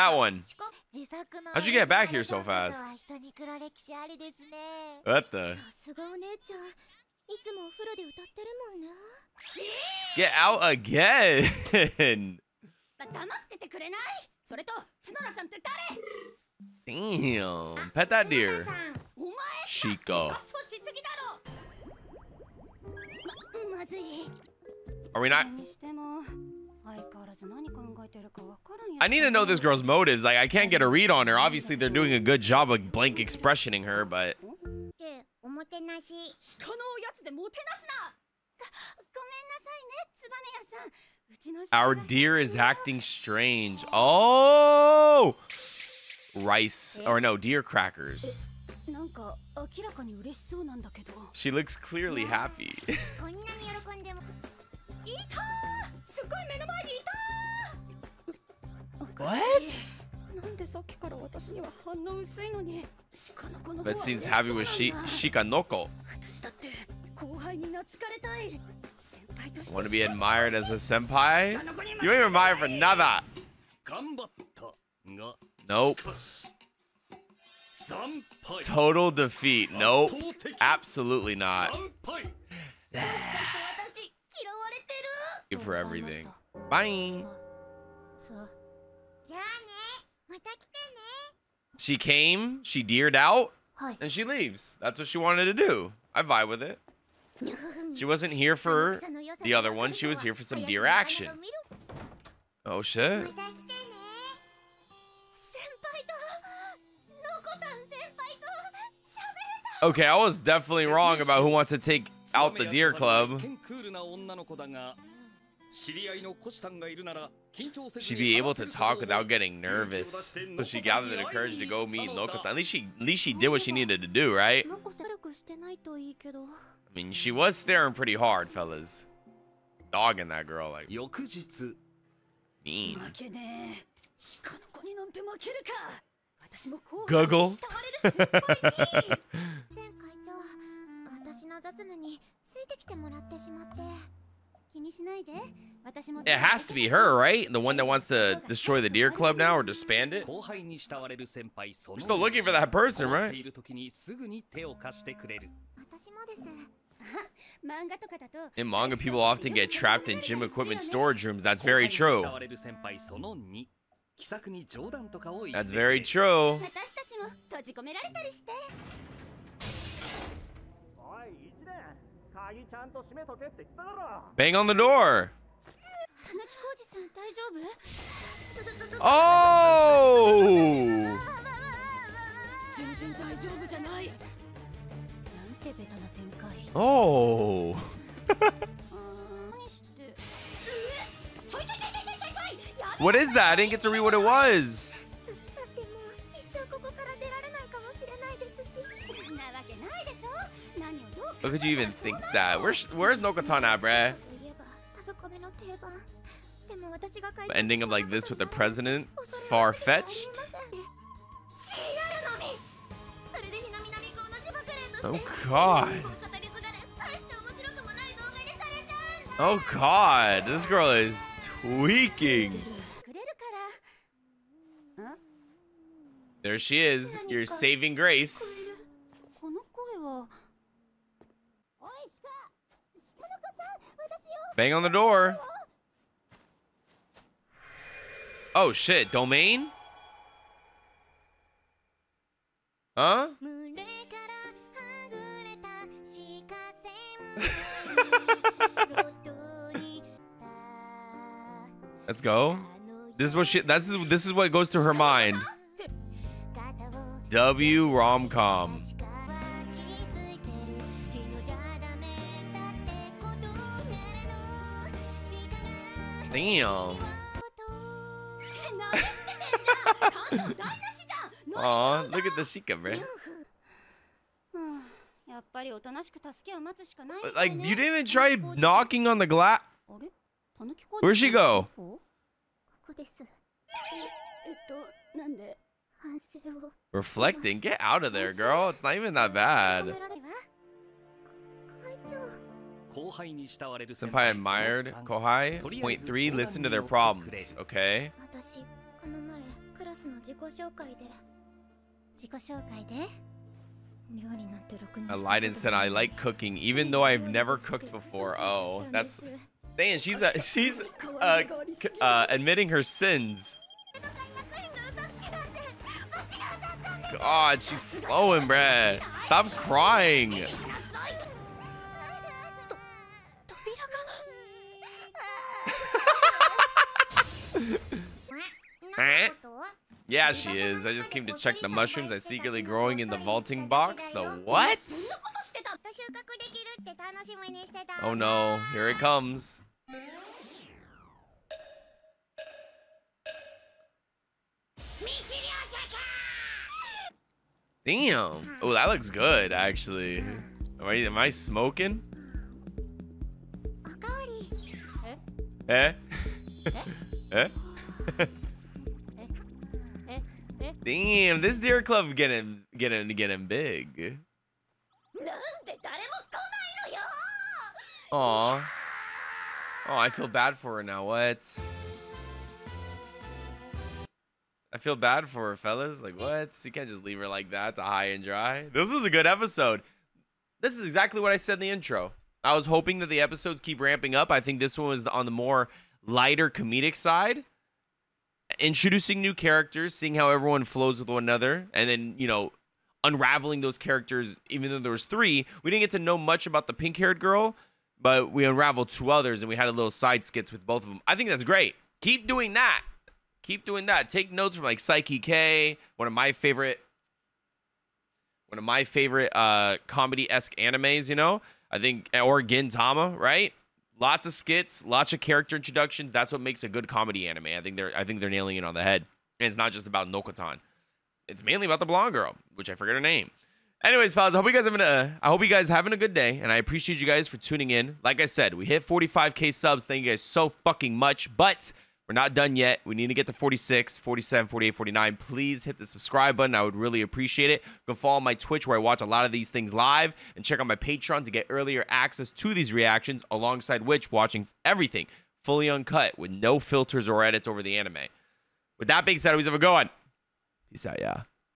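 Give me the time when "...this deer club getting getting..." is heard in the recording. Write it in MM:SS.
06:01.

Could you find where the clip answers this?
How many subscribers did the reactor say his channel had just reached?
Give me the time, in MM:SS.
07:08.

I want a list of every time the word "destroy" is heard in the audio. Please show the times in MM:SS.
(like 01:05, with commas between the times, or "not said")
02:28.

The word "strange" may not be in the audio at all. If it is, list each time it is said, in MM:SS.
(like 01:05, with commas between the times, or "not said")
00:42.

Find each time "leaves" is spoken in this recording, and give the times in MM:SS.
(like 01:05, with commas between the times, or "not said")
01:34, 06:17.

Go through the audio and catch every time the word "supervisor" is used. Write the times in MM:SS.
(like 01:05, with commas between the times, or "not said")
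not said.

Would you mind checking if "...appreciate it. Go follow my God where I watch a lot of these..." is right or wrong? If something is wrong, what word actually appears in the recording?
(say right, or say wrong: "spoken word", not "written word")
wrong: "Twitch", not "God".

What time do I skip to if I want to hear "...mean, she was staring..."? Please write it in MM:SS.
02:06.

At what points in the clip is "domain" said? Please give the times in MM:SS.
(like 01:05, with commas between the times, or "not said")
03:59.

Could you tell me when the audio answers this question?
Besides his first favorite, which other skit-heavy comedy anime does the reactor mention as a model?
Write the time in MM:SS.
06:52.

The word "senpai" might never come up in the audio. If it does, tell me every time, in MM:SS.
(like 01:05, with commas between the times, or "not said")
01:10, 04:52.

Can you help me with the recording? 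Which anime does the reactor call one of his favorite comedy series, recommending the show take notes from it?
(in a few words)
Saiki K.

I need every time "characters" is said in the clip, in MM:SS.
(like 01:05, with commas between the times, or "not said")
06:29, 06:33, 06:55.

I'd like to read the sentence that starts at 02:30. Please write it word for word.
We're still looking for that person, right?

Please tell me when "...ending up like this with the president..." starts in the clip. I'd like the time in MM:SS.
03:27.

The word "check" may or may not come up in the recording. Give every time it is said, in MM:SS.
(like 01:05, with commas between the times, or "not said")
05:31, 07:20.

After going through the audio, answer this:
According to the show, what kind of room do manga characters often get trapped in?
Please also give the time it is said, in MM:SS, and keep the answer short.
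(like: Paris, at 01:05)
Gym equipment storage rooms, at 02:40.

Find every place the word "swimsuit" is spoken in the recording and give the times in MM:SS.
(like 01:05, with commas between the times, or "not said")
not said.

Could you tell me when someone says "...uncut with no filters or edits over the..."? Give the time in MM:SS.
07:25.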